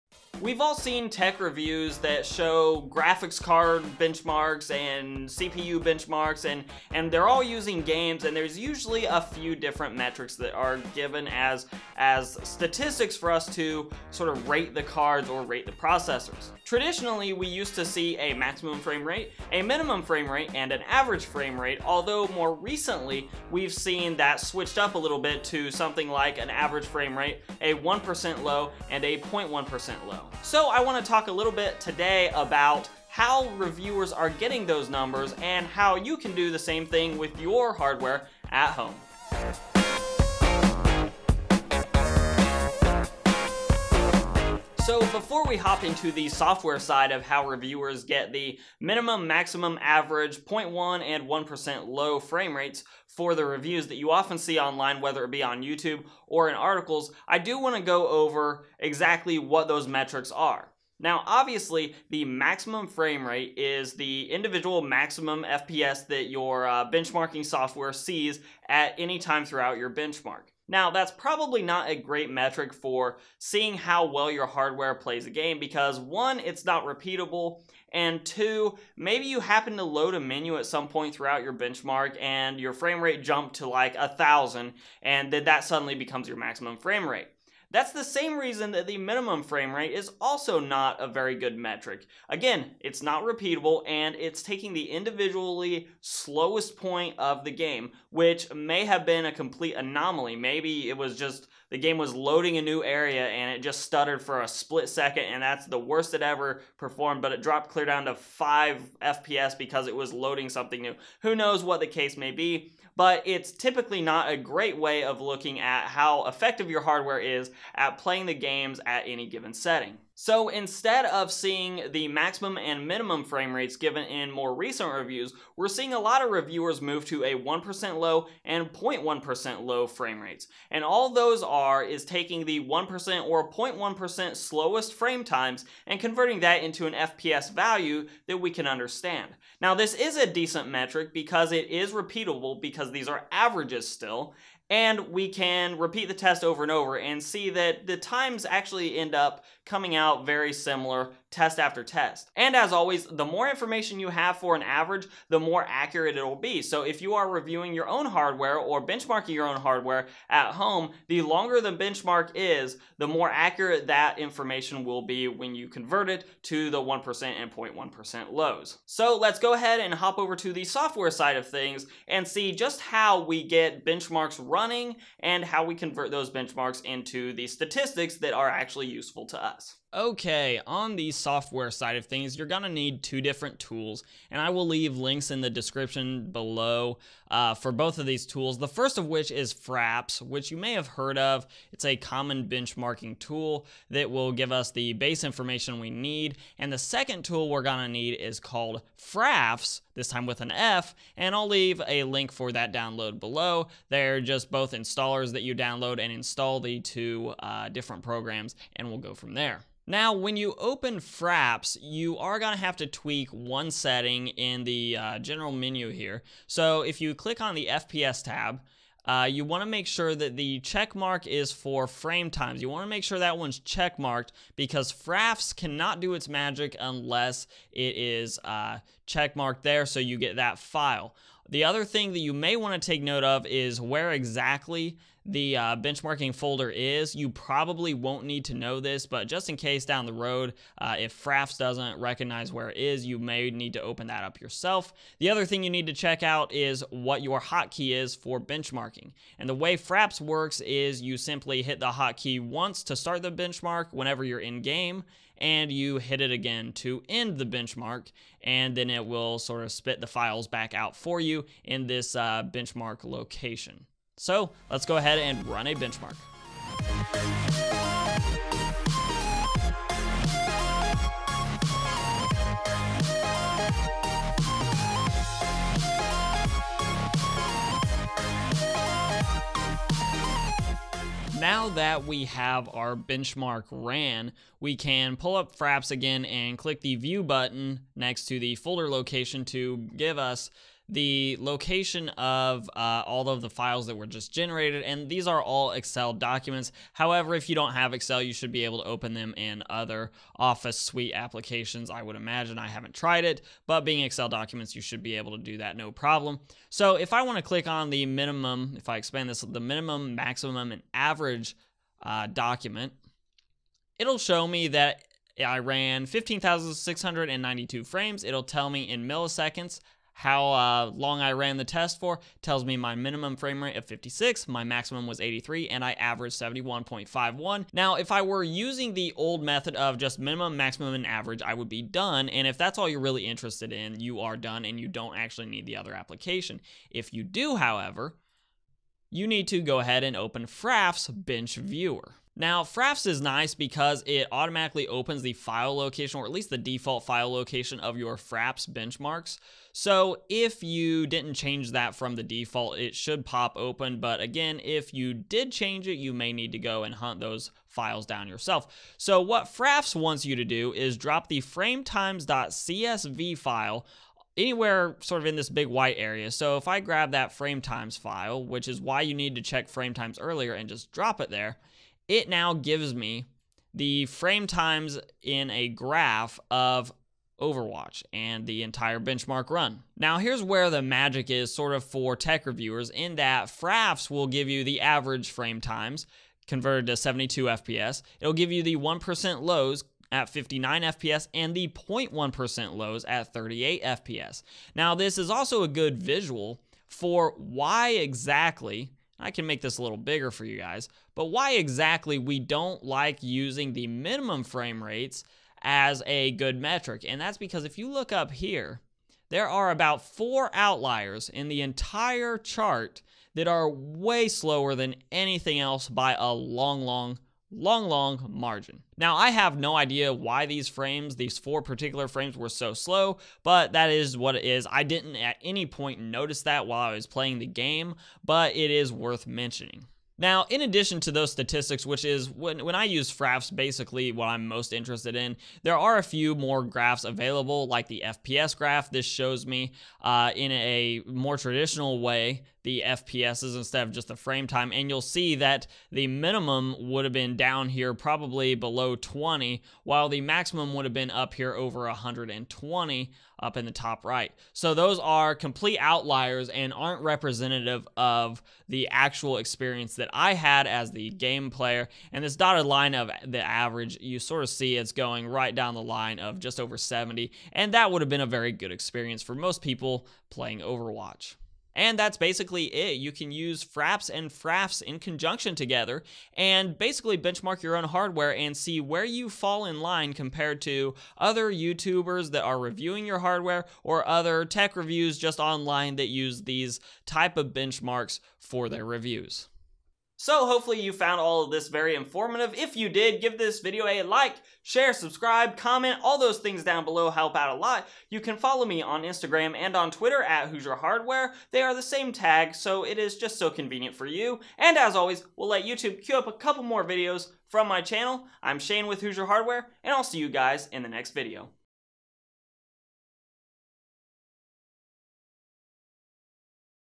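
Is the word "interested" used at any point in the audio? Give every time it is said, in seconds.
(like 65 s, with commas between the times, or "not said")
333 s, 434 s.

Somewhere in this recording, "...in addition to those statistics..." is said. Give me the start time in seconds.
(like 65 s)
430 s.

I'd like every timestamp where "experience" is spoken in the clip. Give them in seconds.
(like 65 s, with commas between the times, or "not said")
459 s, 468 s.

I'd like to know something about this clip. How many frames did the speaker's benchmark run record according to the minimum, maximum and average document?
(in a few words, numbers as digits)
15,692.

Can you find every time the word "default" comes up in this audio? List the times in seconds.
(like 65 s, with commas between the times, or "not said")
346 s, 352 s.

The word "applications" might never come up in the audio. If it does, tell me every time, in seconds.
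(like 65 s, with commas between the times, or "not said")
301 s, 335 s.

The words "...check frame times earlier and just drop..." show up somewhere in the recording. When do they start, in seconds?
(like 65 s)
369 s.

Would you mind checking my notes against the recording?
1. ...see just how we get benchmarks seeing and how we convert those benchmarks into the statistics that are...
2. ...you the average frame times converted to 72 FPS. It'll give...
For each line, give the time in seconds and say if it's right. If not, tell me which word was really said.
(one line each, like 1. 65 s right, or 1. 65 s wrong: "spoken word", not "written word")
1. 172 s wrong: "running", not "seeing"
2. 384 s right.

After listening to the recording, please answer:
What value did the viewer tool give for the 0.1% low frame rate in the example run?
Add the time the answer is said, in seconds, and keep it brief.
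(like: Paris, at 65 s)
38 FPS, at 393 s.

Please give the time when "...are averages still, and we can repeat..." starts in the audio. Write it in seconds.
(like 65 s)
143 s.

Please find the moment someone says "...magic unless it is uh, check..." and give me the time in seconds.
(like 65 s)
226 s.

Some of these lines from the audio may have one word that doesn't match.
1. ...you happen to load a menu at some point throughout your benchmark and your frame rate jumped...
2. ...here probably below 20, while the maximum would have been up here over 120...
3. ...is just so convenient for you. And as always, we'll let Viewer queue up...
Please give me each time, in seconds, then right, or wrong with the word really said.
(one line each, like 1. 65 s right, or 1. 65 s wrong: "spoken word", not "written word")
1. 79 s right
2. 447 s right
3. 502 s wrong: "YouTube", not "Viewer".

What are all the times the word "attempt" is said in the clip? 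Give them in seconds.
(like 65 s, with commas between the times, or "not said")
not said.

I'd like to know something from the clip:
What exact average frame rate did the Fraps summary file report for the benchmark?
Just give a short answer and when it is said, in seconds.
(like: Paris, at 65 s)
71.51, at 326 s.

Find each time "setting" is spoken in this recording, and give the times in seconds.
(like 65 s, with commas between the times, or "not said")
119 s, 213 s.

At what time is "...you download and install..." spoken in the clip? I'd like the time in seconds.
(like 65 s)
205 s.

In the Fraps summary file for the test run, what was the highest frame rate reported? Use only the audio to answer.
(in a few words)
83.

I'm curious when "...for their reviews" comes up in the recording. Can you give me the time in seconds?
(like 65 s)
488 s.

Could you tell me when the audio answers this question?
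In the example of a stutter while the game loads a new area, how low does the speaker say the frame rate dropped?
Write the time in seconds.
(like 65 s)
108 s.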